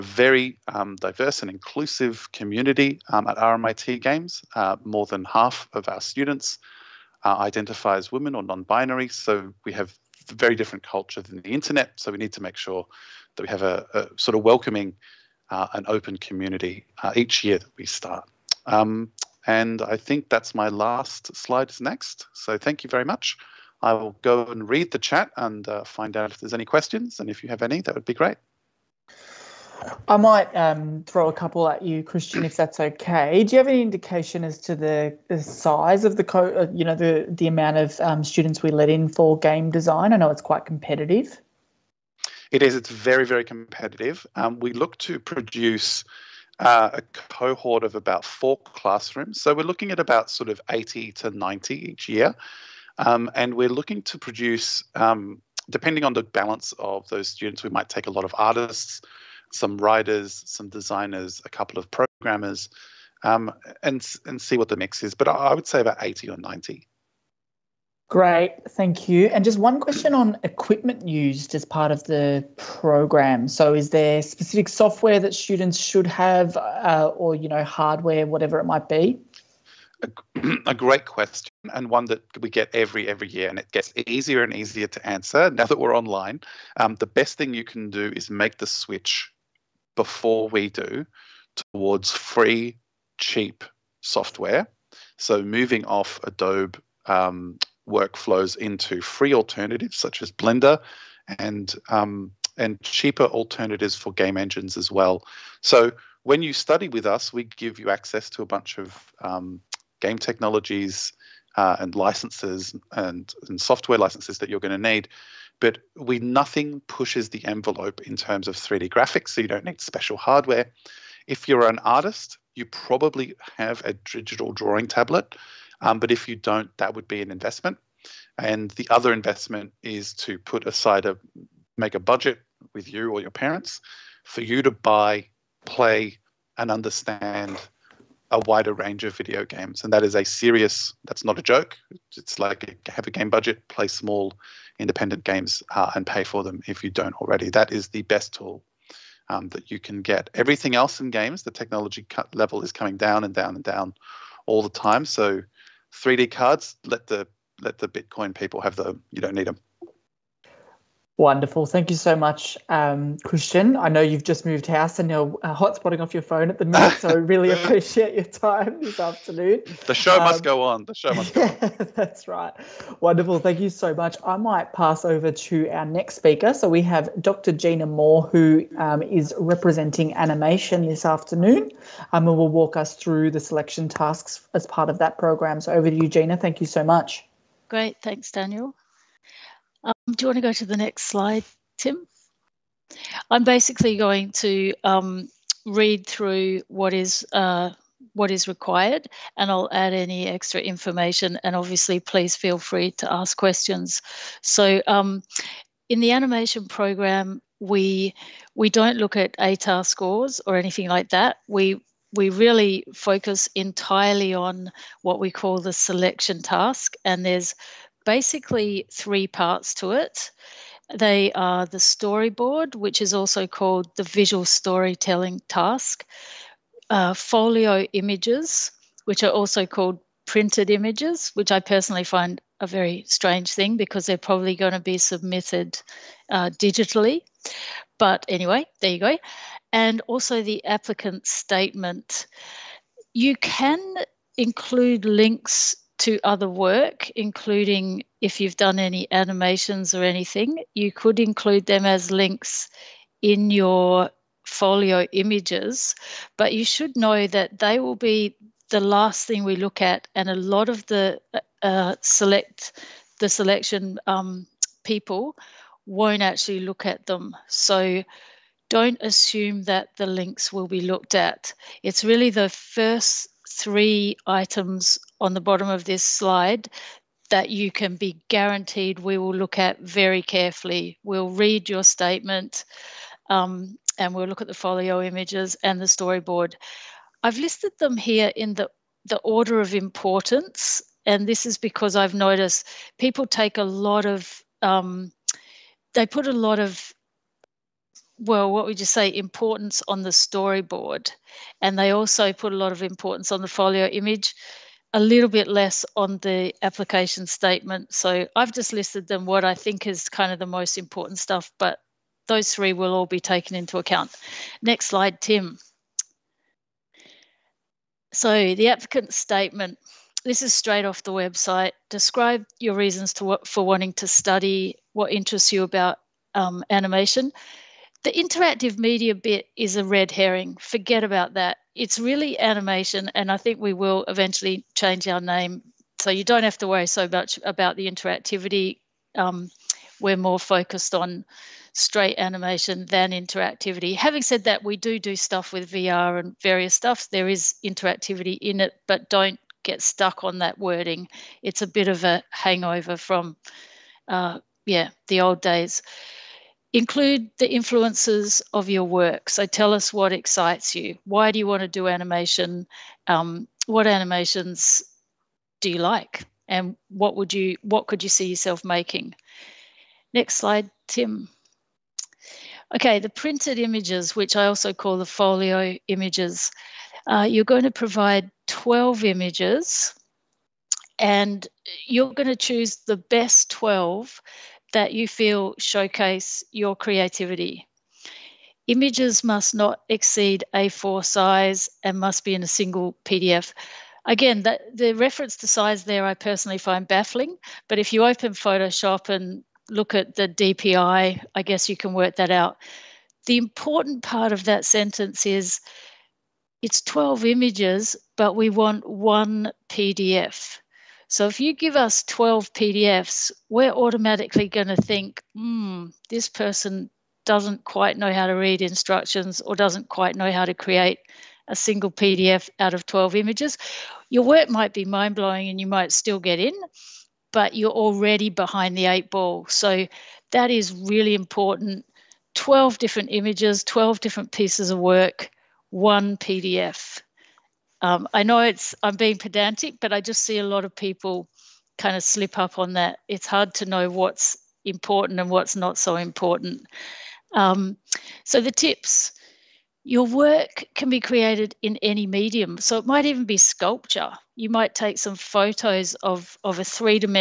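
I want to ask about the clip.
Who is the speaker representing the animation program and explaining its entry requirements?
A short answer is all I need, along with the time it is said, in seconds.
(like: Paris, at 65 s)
Dr. Gina Moore, at 177 s.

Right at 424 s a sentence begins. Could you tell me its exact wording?
Your work might be mind blowing and you might still get in, but you're already behind the eight ball.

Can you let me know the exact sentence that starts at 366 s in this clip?
And what would you what could you see yourself making?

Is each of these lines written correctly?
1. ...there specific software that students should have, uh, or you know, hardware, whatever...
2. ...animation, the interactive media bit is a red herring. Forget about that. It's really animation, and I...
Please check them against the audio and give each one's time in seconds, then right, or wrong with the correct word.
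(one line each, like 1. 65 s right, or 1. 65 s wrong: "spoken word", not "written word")
1. 73 s right
2. 326 s right.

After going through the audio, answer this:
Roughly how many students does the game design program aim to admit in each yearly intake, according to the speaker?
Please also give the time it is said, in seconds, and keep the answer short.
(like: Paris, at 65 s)
80 to 90, at 50 s.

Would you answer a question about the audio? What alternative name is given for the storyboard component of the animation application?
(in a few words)
visual storytelling task.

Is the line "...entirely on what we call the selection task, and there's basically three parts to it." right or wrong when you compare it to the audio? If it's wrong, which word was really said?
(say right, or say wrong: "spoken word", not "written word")
right.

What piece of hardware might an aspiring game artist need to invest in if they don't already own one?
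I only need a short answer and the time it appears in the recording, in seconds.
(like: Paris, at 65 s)
digital drawing tablet, at 123 s.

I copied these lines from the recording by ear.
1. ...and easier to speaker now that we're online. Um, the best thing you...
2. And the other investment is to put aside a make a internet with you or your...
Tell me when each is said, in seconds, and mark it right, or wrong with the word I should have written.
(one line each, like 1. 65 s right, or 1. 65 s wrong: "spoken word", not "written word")
1. 84 s wrong: "answer", not "speaker"
2. 128 s wrong: "budget", not "internet".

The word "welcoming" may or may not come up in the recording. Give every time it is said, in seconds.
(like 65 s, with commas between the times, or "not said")
14 s.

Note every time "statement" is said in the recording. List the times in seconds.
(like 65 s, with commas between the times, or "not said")
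241 s, 281 s, 307 s, 319 s.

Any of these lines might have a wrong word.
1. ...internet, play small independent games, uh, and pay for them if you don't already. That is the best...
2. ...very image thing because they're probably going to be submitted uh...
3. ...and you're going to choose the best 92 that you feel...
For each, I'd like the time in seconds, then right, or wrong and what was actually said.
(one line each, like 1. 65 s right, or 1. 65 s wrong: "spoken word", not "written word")
1. 143 s wrong: "budget", not "internet"
2. 232 s wrong: "strange", not "image"
3. 380 s wrong: "12", not "92".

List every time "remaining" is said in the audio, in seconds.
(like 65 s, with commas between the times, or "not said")
not said.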